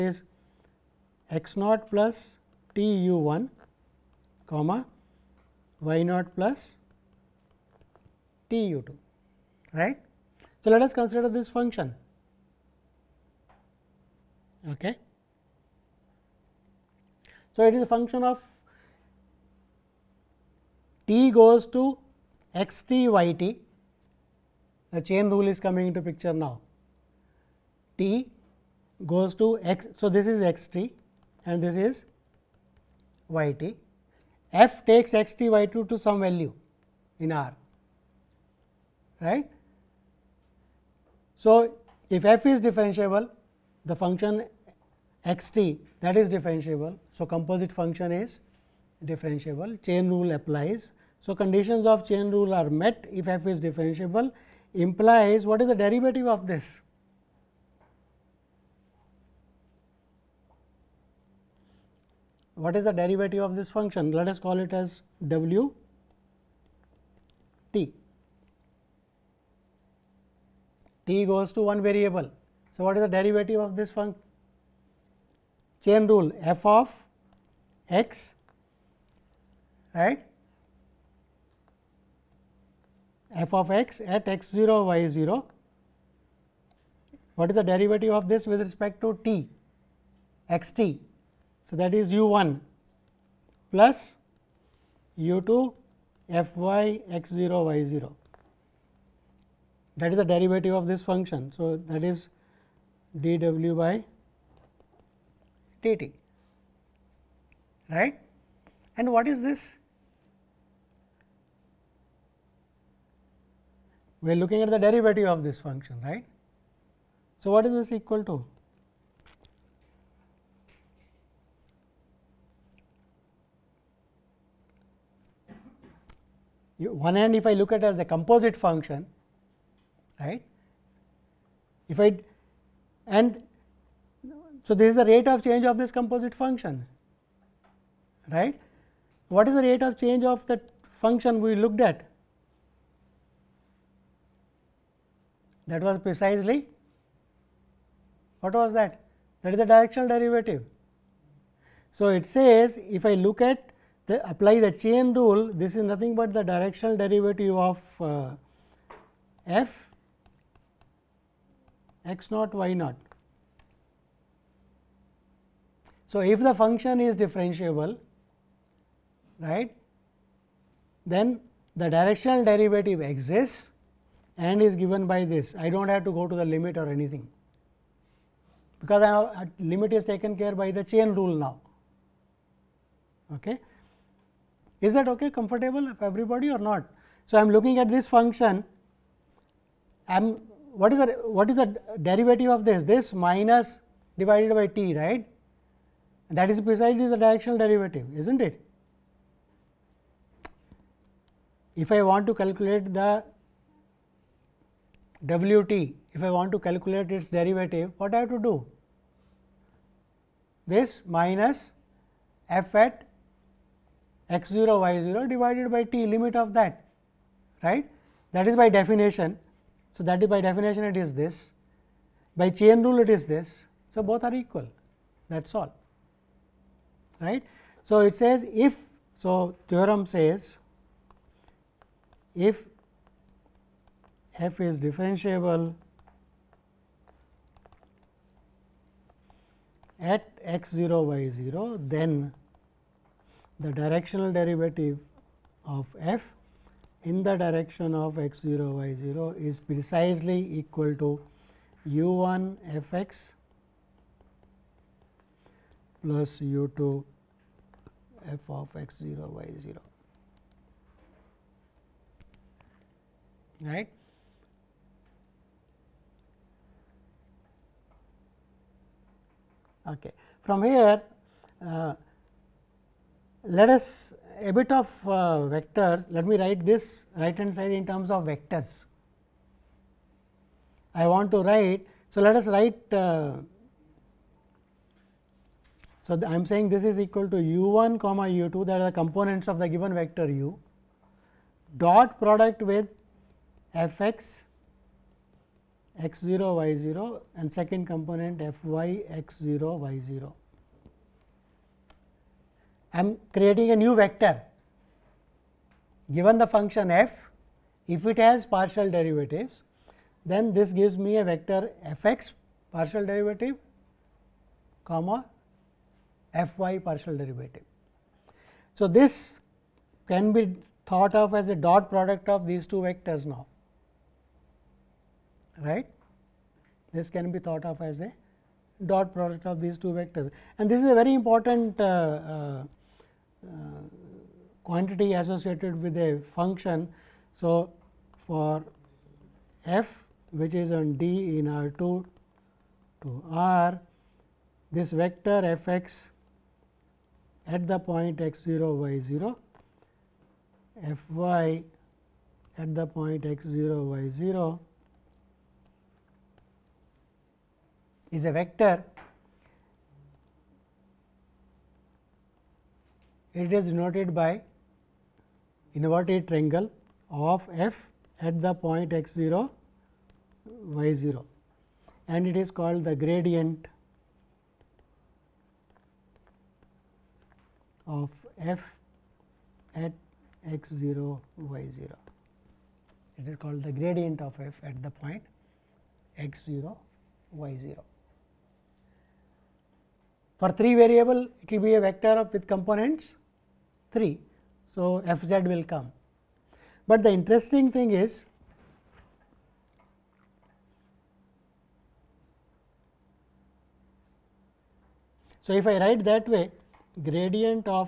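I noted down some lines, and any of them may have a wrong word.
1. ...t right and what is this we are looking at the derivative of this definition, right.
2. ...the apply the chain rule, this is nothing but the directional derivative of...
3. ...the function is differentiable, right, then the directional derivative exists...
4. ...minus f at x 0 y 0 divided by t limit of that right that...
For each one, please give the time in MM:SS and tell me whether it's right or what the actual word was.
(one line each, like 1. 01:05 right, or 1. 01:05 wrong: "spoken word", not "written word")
1. 01:45 wrong: "function", not "definition"
2. 02:34 right
3. 02:46 right
4. 03:31 right.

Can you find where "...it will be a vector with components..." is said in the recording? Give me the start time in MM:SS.
06:31.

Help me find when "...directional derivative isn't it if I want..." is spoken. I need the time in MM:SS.
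03:17.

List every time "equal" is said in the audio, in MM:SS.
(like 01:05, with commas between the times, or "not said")
01:57, 03:44, 04:10, 04:46.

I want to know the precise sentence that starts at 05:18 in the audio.
So, this can be thought of as a dot product of these two vectors now right.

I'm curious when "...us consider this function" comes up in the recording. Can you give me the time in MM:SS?
00:10.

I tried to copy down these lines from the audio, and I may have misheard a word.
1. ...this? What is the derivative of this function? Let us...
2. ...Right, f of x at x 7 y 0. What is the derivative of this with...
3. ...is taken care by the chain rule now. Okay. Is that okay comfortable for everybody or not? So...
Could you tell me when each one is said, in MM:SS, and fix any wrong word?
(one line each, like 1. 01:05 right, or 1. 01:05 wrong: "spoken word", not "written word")
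1. 00:56 right
2. 01:19 wrong: "0", not "7"
3. 02:59 right.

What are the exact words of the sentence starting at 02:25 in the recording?
that was precisely what was that?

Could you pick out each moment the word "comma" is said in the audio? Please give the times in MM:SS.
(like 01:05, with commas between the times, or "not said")
00:04, 04:47, 05:14.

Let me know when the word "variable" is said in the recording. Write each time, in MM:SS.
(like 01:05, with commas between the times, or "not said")
01:11, 06:30.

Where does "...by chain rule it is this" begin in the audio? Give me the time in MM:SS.
03:42.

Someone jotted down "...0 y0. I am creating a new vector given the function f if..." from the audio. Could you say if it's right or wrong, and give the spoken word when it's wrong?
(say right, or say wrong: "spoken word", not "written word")
right.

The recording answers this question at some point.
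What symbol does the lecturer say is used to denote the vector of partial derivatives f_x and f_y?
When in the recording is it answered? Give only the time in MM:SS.
06:05.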